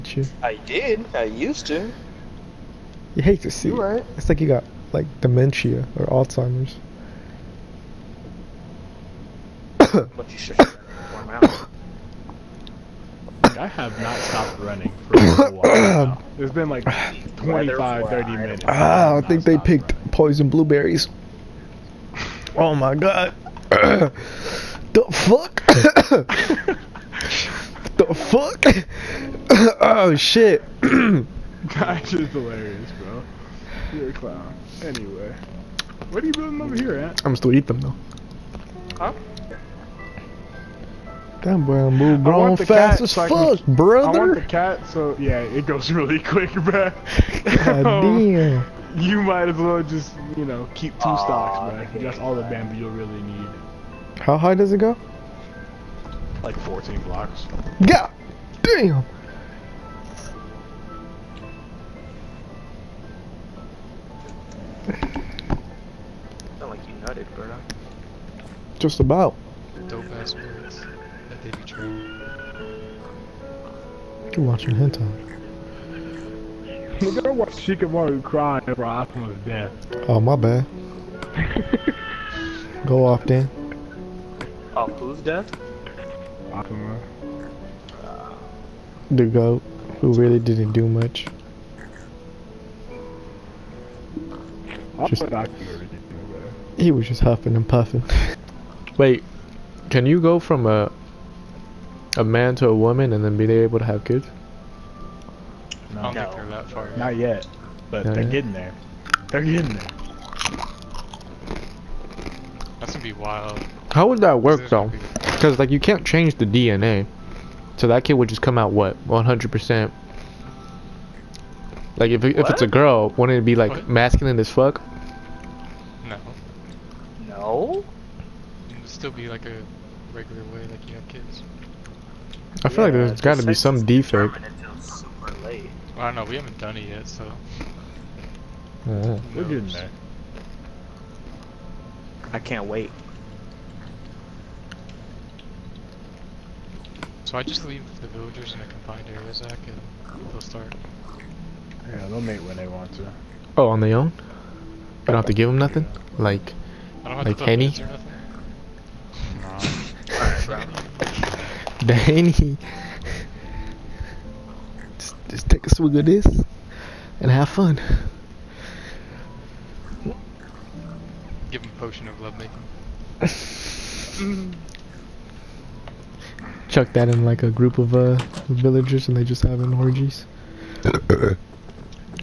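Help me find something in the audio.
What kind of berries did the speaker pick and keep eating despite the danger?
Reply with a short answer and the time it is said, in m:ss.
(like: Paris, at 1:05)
poison blueberries, at 0:20.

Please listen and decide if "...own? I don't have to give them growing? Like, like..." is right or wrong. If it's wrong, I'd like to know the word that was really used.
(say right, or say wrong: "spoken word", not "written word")
wrong: "nothing", not "growing".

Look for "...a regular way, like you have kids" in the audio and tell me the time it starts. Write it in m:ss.
2:09.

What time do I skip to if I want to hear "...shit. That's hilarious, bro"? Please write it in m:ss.
0:30.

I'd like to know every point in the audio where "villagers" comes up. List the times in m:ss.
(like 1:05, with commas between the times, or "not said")
2:28, 2:58.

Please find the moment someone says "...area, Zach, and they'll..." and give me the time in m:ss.
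2:29.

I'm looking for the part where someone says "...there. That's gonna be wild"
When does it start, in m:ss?
1:49.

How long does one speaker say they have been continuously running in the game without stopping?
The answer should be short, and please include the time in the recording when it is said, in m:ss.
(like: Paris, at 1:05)
25-30 minutes, at 0:17.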